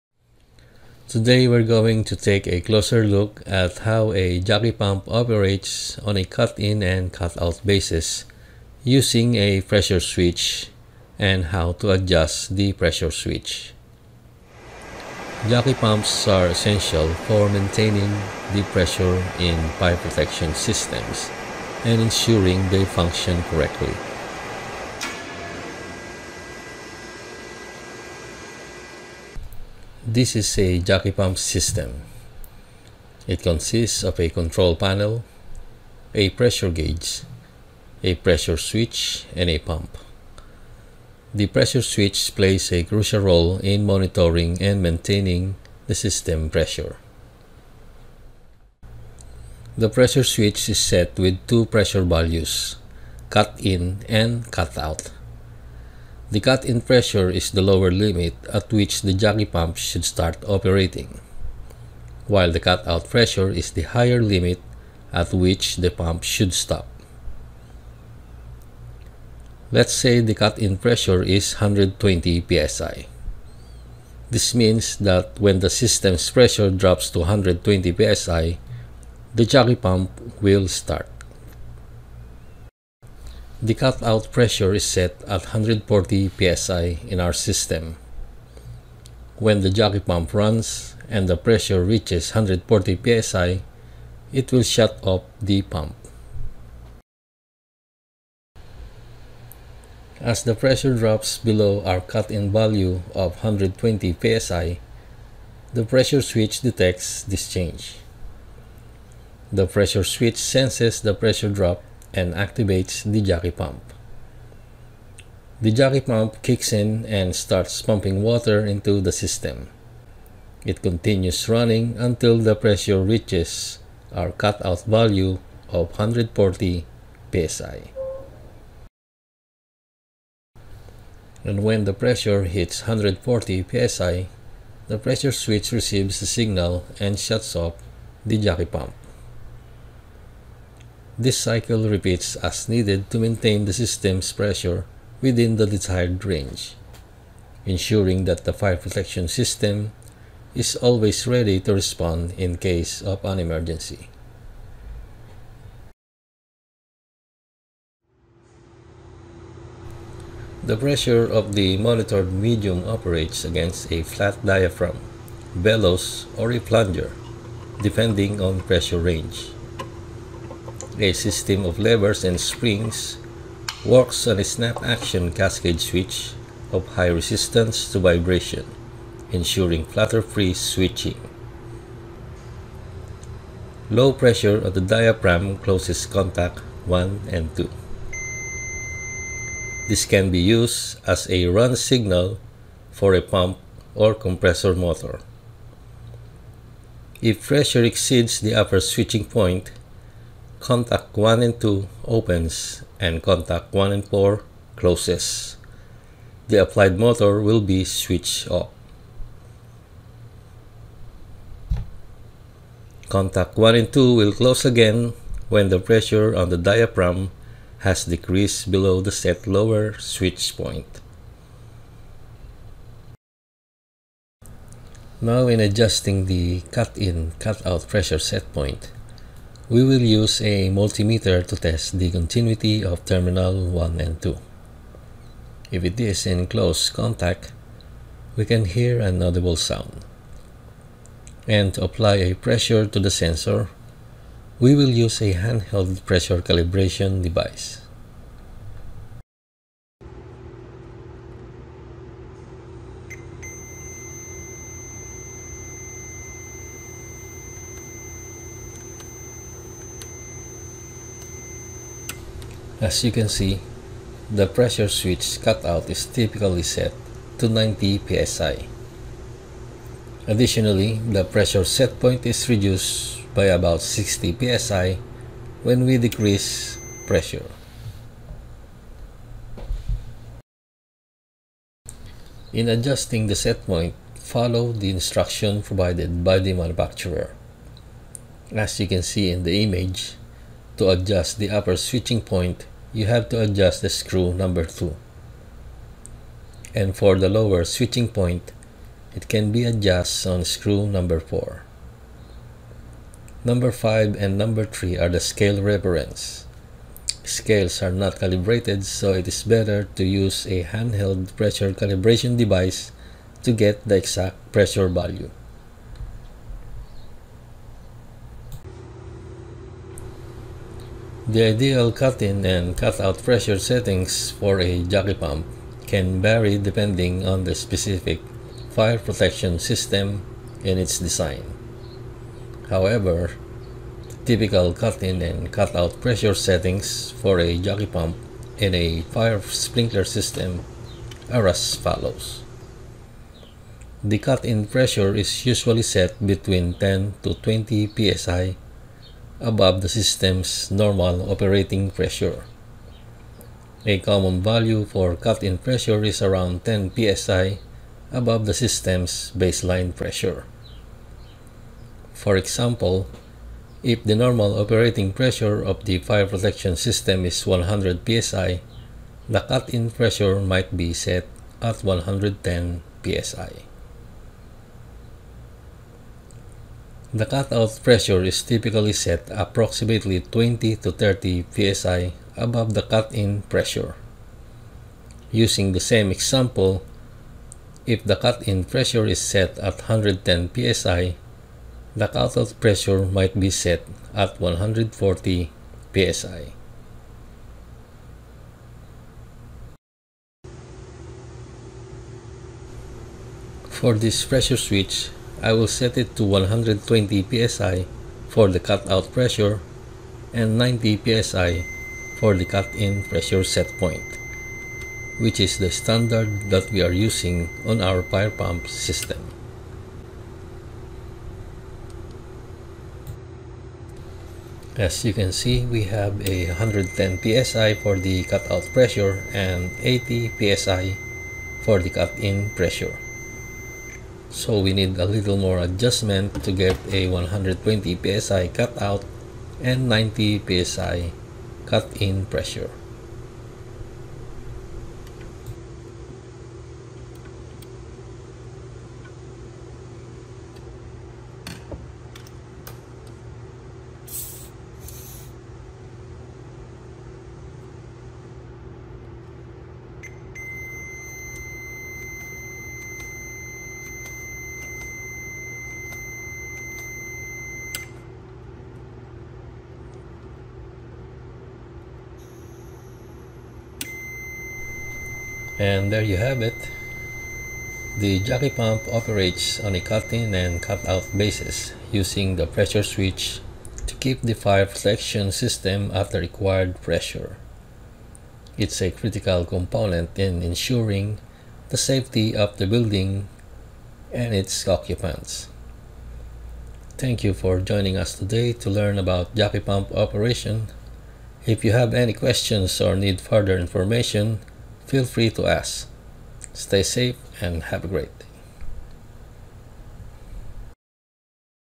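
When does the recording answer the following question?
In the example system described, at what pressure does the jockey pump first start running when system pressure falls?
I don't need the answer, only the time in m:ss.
1:10.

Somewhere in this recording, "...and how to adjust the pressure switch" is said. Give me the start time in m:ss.
0:11.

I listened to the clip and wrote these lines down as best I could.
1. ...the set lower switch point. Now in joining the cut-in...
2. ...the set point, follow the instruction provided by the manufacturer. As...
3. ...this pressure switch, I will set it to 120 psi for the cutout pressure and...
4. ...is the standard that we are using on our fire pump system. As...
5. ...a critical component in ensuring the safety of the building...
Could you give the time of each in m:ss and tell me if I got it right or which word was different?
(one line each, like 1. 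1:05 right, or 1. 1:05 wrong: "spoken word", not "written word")
1. 3:39 wrong: "adjusting", not "joining"
2. 4:43 right
3. 6:43 right
4. 6:55 right
5. 8:08 right.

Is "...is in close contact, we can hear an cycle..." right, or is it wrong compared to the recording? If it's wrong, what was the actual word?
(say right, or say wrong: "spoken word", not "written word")
wrong: "audible", not "cycle".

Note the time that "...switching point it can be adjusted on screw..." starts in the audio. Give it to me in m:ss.
4:57.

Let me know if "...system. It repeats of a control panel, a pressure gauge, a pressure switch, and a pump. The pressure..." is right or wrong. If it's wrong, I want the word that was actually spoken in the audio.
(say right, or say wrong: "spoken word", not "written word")
wrong: "consists", not "repeats".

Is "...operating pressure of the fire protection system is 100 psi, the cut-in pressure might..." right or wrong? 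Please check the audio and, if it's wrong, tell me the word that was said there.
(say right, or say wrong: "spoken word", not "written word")
right.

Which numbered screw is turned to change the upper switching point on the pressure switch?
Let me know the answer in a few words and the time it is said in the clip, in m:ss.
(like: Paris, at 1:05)
2, at 4:53.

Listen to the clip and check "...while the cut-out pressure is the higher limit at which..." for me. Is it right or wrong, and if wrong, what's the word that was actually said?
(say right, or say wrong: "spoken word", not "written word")
right.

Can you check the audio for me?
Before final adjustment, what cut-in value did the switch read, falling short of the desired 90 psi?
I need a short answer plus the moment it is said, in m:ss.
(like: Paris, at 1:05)
80 psi, at 7:09.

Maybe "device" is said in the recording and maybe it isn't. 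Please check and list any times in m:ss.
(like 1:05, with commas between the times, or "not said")
4:07, 5:12.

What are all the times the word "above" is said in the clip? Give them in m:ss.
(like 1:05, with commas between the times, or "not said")
5:49, 5:58, 6:22.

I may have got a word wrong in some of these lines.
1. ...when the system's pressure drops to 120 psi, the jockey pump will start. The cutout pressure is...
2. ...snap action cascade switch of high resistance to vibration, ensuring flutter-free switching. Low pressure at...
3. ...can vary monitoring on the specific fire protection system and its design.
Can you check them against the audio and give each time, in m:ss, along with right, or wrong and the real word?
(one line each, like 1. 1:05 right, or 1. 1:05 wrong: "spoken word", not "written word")
1. 1:15 right
2. 2:54 right
3. 5:25 wrong: "depending", not "monitoring".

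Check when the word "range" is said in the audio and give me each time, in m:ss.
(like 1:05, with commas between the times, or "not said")
2:26, 2:48.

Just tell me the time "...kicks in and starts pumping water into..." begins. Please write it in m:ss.
1:56.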